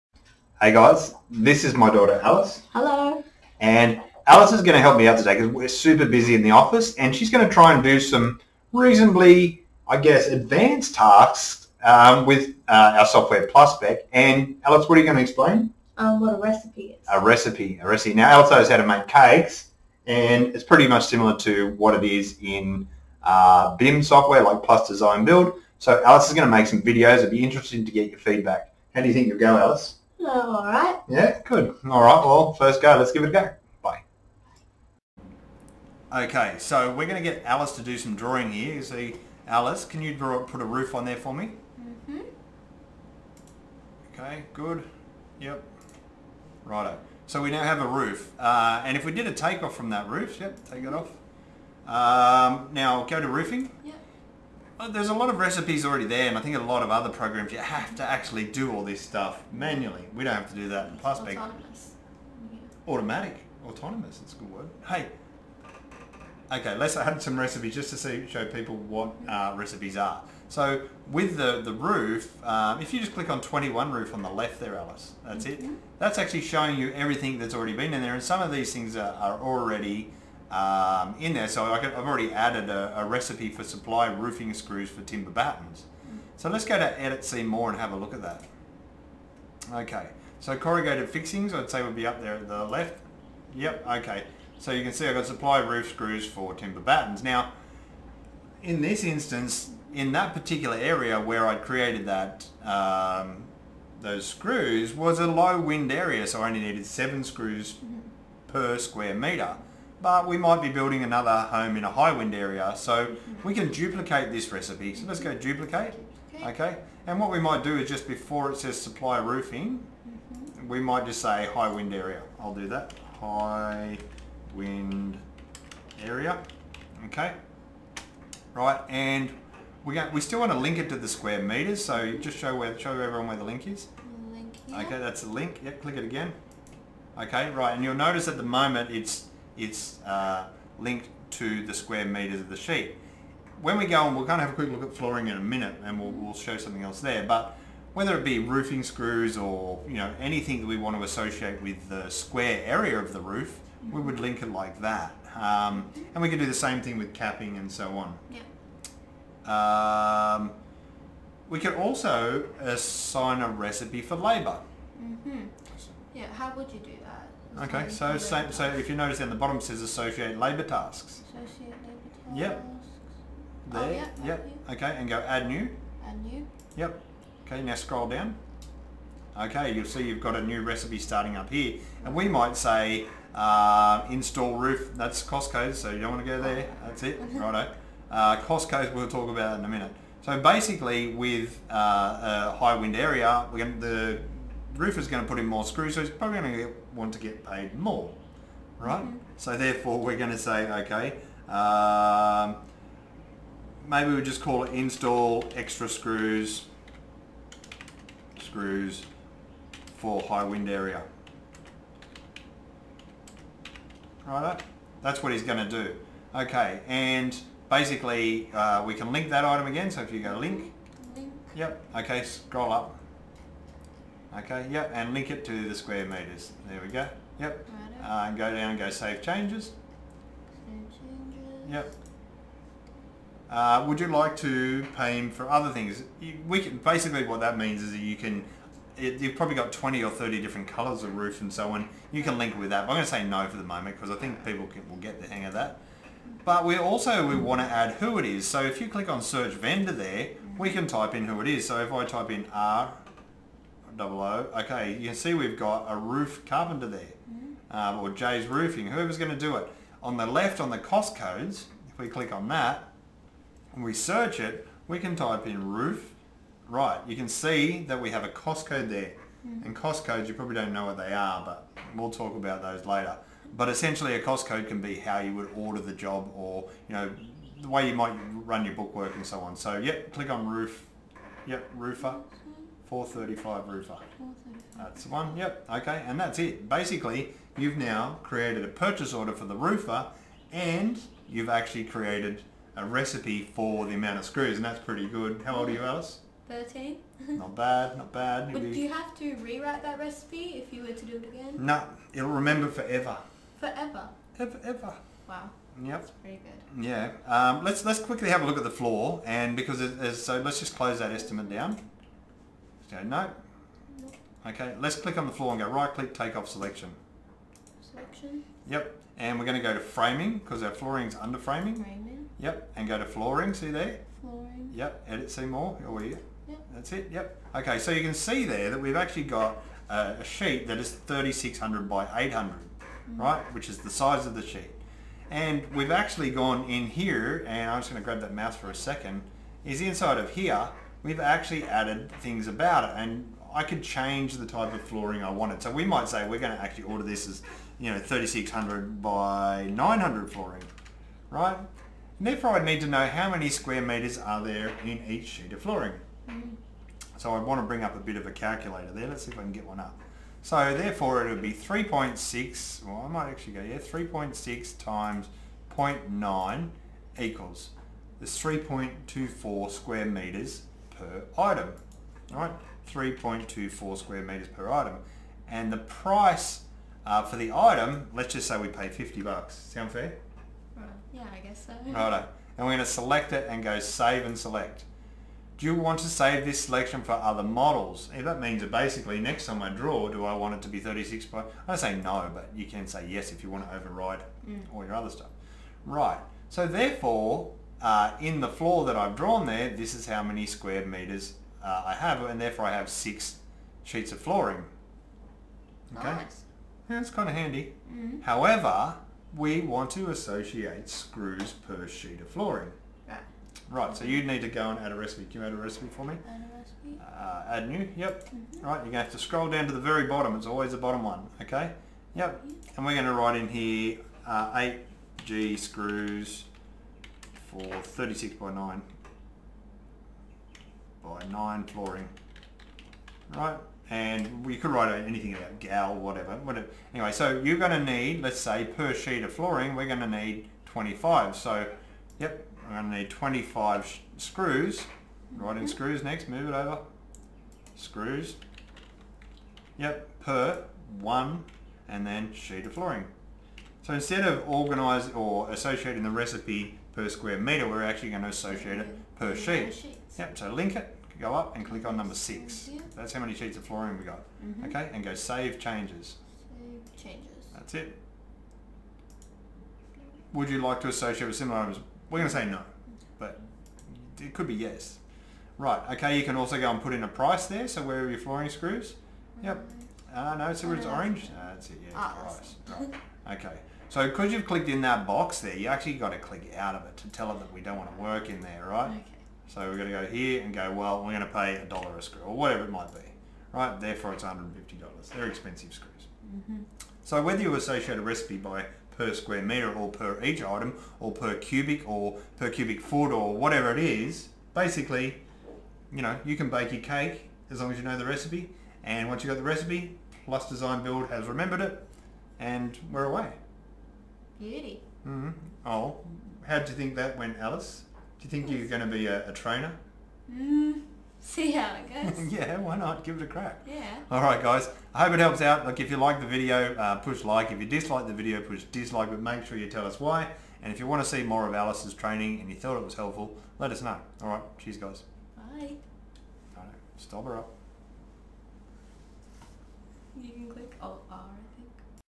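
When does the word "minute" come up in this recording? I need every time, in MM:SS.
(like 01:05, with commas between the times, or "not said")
02:25, 03:09.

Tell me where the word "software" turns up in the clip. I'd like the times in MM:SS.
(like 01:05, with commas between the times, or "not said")
00:13, 00:24.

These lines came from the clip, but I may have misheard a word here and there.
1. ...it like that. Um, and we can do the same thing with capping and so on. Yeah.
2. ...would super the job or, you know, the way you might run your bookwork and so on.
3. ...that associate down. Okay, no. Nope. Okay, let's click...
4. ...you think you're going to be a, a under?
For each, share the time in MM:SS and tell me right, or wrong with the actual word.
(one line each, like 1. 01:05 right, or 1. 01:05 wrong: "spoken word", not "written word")
1. 02:34 right
2. 04:35 wrong: "order", not "super"
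3. 05:10 wrong: "estimate", not "associate"
4. 08:38 wrong: "trainer", not "under".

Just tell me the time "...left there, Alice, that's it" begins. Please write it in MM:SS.
01:14.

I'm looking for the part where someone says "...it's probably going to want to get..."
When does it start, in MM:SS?
03:16.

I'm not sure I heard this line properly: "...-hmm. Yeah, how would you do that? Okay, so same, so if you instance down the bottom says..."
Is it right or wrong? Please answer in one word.
wrong.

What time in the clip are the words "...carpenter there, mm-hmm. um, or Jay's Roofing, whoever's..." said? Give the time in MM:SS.
04:16.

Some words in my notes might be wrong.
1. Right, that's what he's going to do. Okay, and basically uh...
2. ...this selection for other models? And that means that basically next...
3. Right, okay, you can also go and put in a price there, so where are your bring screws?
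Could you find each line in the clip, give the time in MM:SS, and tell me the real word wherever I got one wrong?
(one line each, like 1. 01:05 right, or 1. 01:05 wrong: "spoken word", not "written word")
1. 03:34 right
2. 06:26 right
3. 07:55 wrong: "flooring", not "bring".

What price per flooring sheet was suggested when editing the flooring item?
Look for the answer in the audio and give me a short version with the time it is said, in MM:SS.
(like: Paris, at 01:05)
$50, at 06:18.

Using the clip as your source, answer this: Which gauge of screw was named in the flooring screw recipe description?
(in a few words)
8G.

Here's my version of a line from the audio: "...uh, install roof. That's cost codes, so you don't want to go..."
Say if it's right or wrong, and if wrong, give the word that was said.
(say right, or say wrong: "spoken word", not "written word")
right.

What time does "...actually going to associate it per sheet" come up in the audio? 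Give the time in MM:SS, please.
07:37.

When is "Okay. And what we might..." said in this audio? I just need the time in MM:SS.
01:56.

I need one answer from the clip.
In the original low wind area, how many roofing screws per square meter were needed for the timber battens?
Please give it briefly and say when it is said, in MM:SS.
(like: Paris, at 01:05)
7, at 01:46.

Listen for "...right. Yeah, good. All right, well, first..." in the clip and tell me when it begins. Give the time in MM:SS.
00:30.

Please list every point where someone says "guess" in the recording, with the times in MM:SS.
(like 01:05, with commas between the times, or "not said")
00:09, 06:21.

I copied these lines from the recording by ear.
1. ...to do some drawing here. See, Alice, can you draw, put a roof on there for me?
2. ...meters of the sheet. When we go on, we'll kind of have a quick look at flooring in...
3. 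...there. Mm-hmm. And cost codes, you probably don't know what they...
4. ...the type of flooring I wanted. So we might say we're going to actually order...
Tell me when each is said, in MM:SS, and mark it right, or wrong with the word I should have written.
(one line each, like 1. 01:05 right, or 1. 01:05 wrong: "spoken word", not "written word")
1. 00:37 right
2. 02:22 right
3. 04:28 right
4. 05:44 right.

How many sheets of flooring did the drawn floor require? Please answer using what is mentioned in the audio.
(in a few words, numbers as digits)
6.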